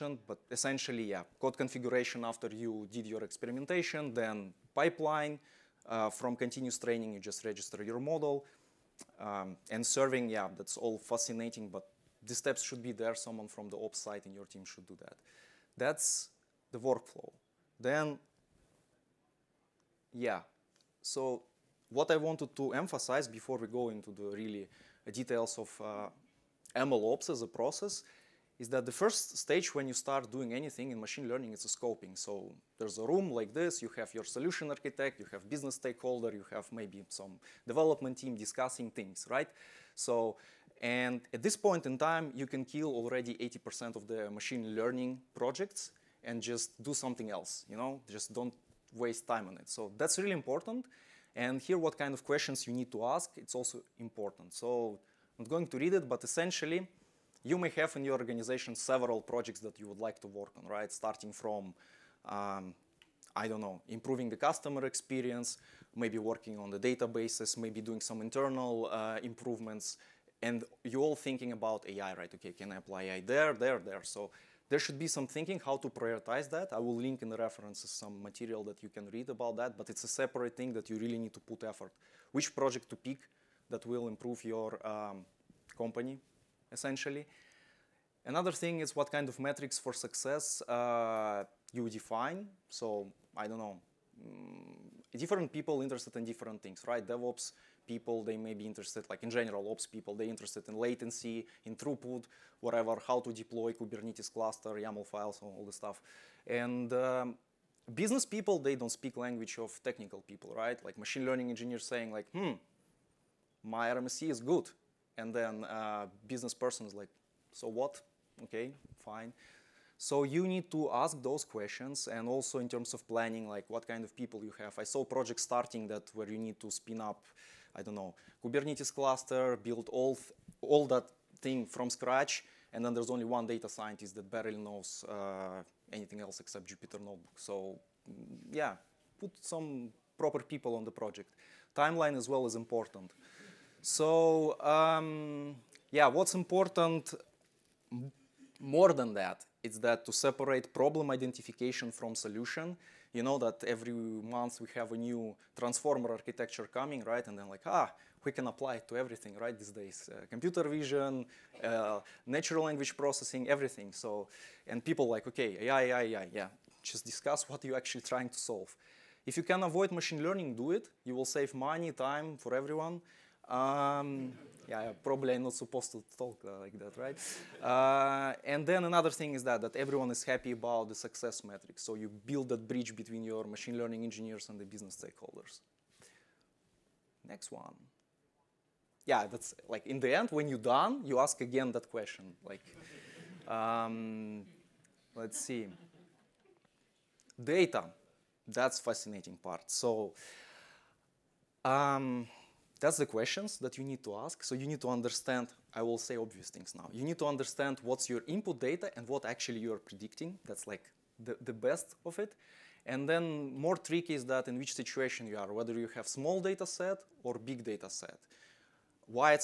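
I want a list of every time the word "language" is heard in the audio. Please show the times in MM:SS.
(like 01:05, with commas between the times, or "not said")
01:49, 02:42.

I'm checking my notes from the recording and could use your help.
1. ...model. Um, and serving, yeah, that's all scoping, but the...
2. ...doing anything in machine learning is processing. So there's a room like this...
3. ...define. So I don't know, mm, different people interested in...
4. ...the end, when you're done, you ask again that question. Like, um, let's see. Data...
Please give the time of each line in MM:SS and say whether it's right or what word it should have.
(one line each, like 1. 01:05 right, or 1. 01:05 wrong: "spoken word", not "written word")
1. 00:08 wrong: "fascinating", not "scoping"
2. 00:30 wrong: "scoping", not "processing"
3. 01:31 right
4. 03:10 right.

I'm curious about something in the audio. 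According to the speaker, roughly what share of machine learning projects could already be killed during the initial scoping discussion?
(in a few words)
80%.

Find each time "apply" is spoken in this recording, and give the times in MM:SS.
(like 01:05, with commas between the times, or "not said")
01:12, 02:38.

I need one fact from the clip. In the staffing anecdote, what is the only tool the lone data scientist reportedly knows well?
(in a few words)
Jupyter Notebook.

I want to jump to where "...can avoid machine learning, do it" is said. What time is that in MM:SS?
02:49.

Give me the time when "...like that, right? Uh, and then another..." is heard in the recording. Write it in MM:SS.
02:56.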